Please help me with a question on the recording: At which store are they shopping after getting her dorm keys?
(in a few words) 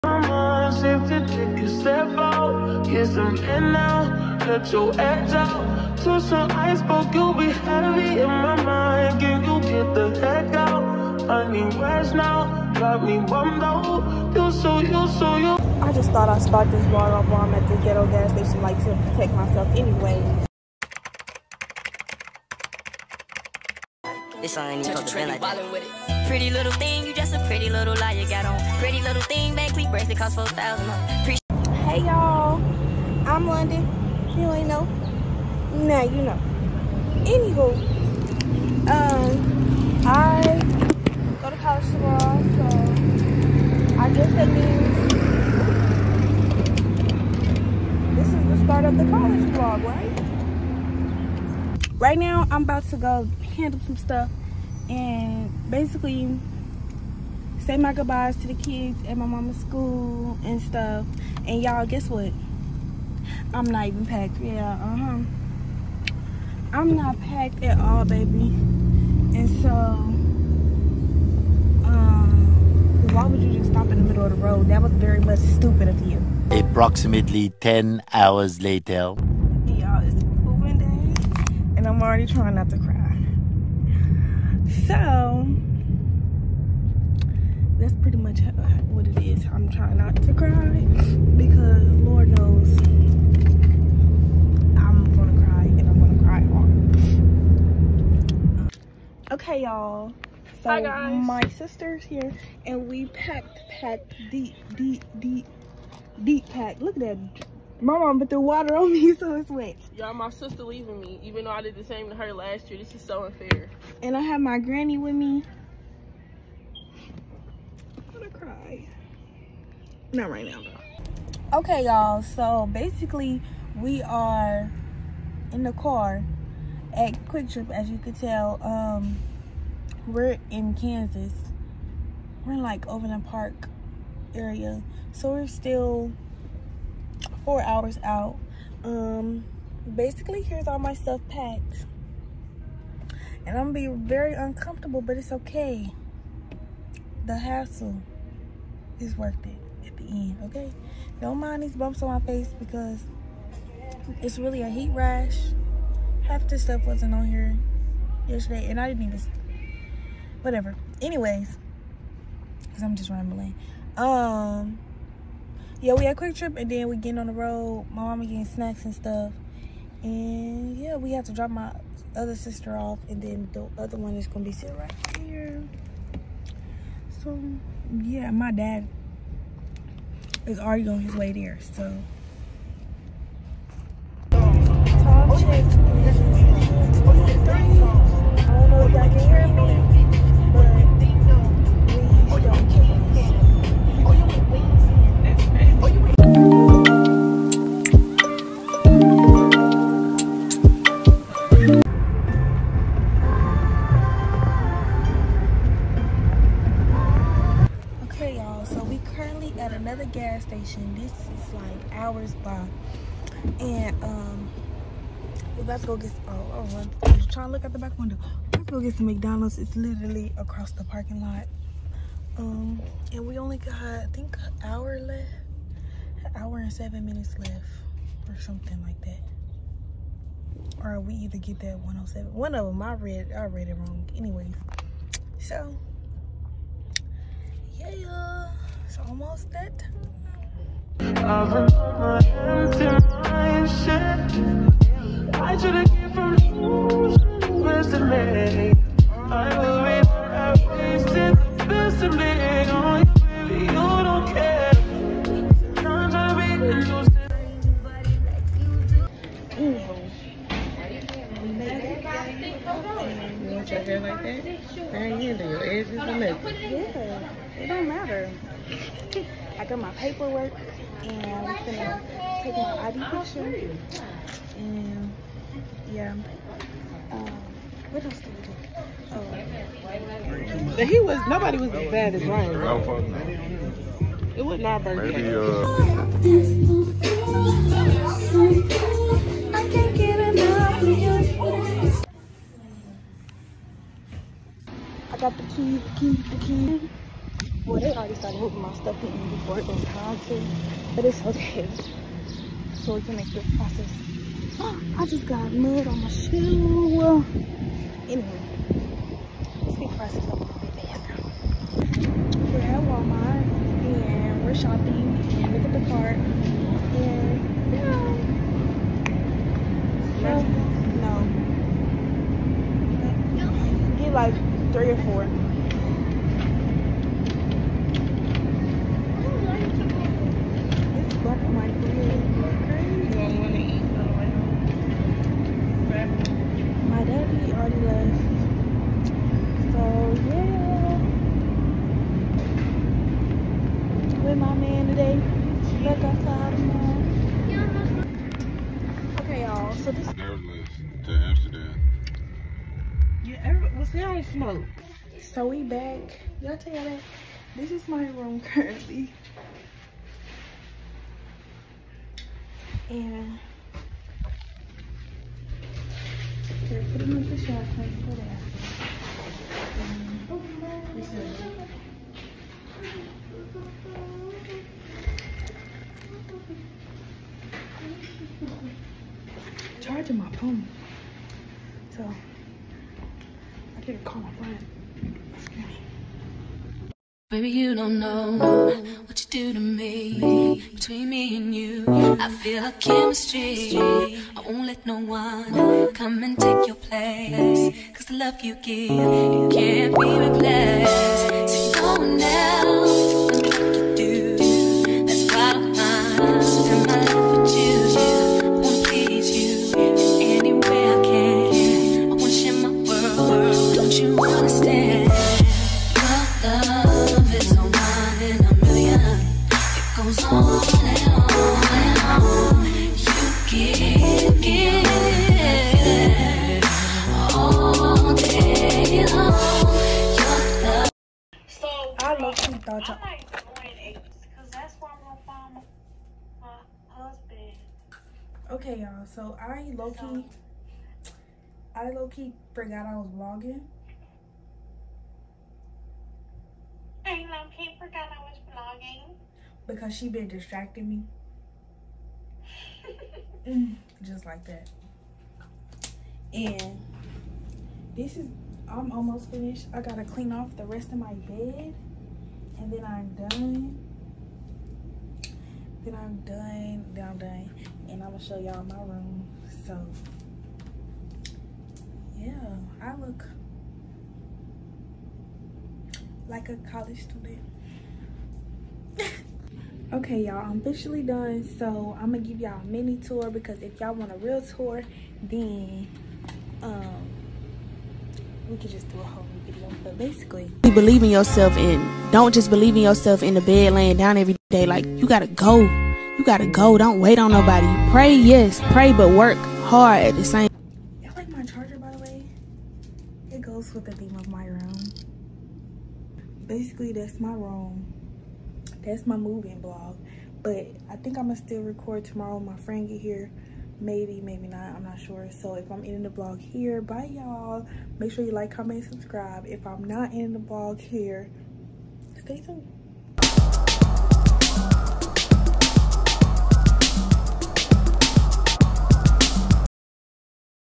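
Walmart.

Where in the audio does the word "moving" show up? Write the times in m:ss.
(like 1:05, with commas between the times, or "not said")
1:20, 4:58, 8:29.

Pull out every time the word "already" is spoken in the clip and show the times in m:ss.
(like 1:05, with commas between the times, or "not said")
1:22, 3:00, 4:57.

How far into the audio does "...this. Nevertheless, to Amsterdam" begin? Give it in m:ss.
5:49.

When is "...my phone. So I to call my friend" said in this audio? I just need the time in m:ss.
6:20.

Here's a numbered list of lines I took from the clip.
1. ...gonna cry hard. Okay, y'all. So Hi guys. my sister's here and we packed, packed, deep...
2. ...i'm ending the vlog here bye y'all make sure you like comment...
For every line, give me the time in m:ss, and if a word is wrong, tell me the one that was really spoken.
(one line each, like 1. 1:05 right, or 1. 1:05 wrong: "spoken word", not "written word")
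1. 1:35 right
2. 8:35 right.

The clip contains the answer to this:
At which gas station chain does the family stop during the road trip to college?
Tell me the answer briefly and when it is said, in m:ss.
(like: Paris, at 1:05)
QuikTrip, at 2:07.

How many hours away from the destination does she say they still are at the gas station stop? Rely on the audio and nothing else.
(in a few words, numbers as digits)
4 hours.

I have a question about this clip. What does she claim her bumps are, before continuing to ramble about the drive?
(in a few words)
heat rash.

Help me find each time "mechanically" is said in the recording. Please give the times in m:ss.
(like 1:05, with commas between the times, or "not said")
not said.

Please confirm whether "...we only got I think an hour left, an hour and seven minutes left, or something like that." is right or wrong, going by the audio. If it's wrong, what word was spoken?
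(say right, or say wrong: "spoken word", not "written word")
right.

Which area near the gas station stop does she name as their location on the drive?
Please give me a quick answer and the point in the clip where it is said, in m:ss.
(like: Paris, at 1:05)
Overland Park, at 2:12.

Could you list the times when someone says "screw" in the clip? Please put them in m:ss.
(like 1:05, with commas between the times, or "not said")
not said.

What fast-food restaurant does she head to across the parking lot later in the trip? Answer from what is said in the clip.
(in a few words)
McDonald's.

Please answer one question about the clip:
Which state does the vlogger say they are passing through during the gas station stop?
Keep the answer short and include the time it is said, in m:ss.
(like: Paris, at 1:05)
Kansas, at 2:10.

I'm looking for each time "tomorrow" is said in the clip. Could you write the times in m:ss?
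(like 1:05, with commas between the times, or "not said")
0:41, 8:32.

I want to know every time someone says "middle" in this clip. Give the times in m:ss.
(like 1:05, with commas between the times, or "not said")
1:14.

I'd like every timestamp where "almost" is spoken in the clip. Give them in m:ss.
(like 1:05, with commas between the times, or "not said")
3:58, 7:38.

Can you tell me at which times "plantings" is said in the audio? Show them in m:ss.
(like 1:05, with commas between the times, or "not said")
not said.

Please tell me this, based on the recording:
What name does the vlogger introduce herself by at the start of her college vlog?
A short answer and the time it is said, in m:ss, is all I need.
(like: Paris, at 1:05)
Londyn, at 0:33.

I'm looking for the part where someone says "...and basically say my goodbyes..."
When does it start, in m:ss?
0:54.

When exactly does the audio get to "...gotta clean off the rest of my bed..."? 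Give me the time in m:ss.
7:39.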